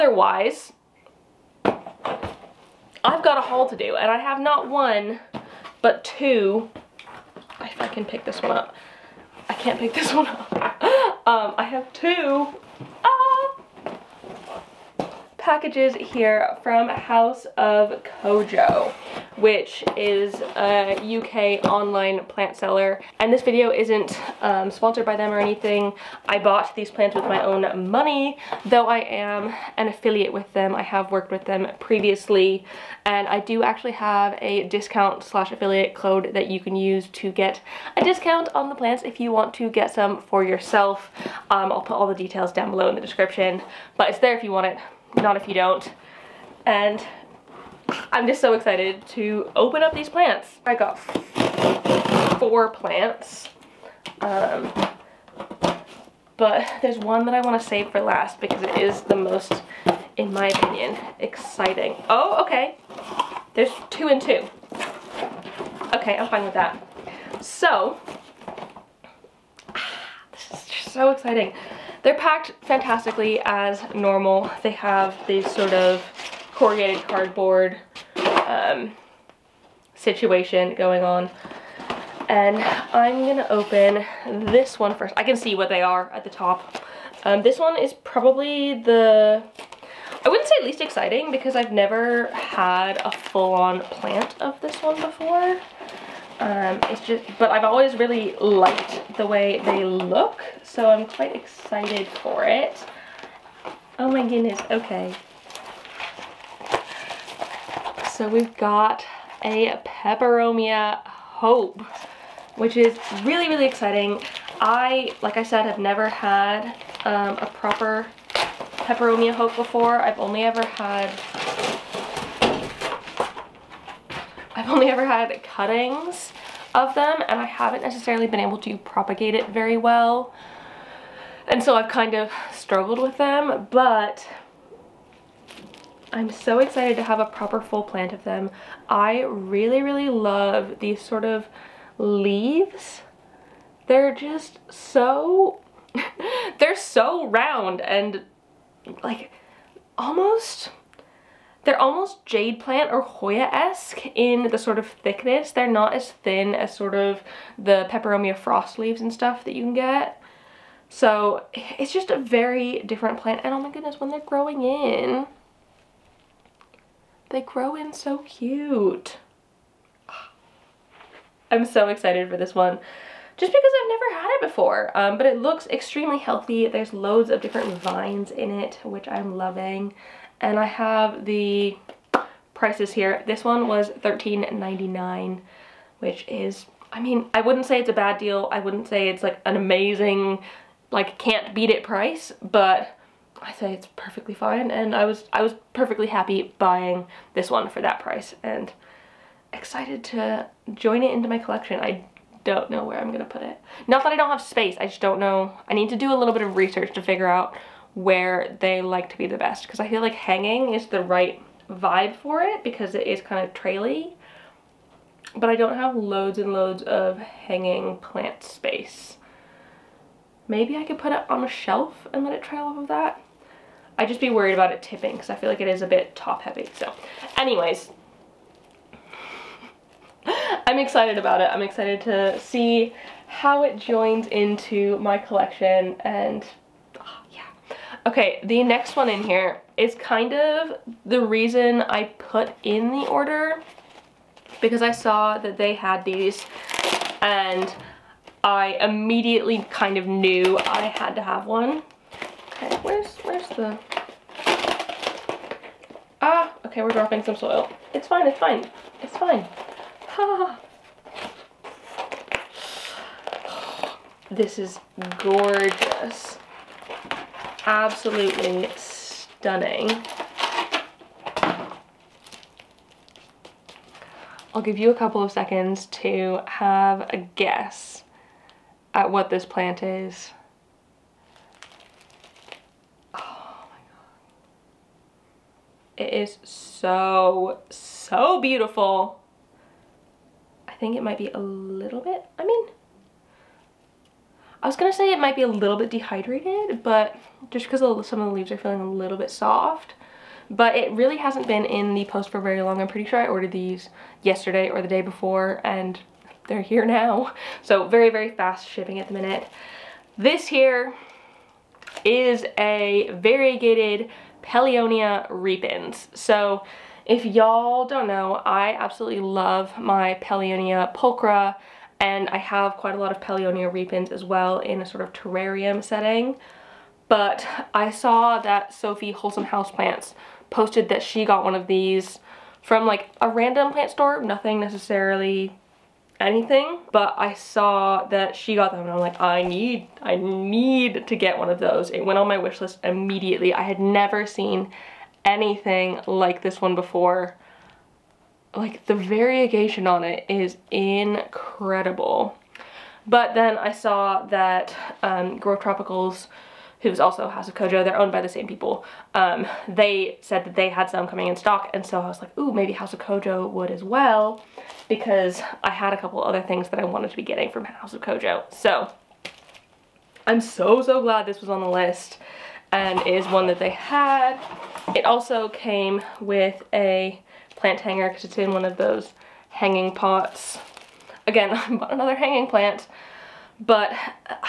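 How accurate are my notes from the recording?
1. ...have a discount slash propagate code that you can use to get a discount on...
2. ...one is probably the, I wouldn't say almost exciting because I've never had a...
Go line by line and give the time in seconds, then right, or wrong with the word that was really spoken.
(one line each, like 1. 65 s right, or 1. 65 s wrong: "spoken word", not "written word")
1. 33 s wrong: "affiliate", not "propagate"
2. 87 s wrong: "least", not "almost".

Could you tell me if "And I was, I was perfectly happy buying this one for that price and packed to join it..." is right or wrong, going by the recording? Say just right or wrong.
wrong.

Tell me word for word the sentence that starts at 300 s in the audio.
But it really hasn't been in the post for very long.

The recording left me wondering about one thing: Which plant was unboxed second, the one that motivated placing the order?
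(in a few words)
variegated Pellionia repens.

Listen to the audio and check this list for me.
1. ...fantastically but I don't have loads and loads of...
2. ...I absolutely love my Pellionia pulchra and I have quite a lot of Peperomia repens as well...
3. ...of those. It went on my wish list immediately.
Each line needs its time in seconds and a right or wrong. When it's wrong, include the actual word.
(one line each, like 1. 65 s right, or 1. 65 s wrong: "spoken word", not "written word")
1. 213 s wrong: "traily", not "fantastically"
2. 318 s wrong: "Pellionia", not "Peperomia"
3. 341 s right.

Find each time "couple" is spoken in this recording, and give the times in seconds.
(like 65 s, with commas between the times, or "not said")
274 s, 365 s.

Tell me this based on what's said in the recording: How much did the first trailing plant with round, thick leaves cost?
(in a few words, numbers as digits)
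$13.99.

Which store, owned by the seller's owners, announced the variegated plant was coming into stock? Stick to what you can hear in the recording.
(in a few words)
Grow Tropicals.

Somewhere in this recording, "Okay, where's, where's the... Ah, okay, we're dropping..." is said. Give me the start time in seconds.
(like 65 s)
252 s.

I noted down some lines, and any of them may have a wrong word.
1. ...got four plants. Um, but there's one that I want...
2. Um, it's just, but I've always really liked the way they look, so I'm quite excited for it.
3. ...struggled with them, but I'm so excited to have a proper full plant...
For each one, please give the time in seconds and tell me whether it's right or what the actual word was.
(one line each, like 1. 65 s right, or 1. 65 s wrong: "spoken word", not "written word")
1. 50 s right
2. 96 s right
3. 132 s right.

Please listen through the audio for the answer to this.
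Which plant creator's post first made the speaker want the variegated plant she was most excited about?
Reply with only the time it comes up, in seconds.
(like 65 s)
328 s.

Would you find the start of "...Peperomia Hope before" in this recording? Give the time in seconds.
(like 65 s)
118 s.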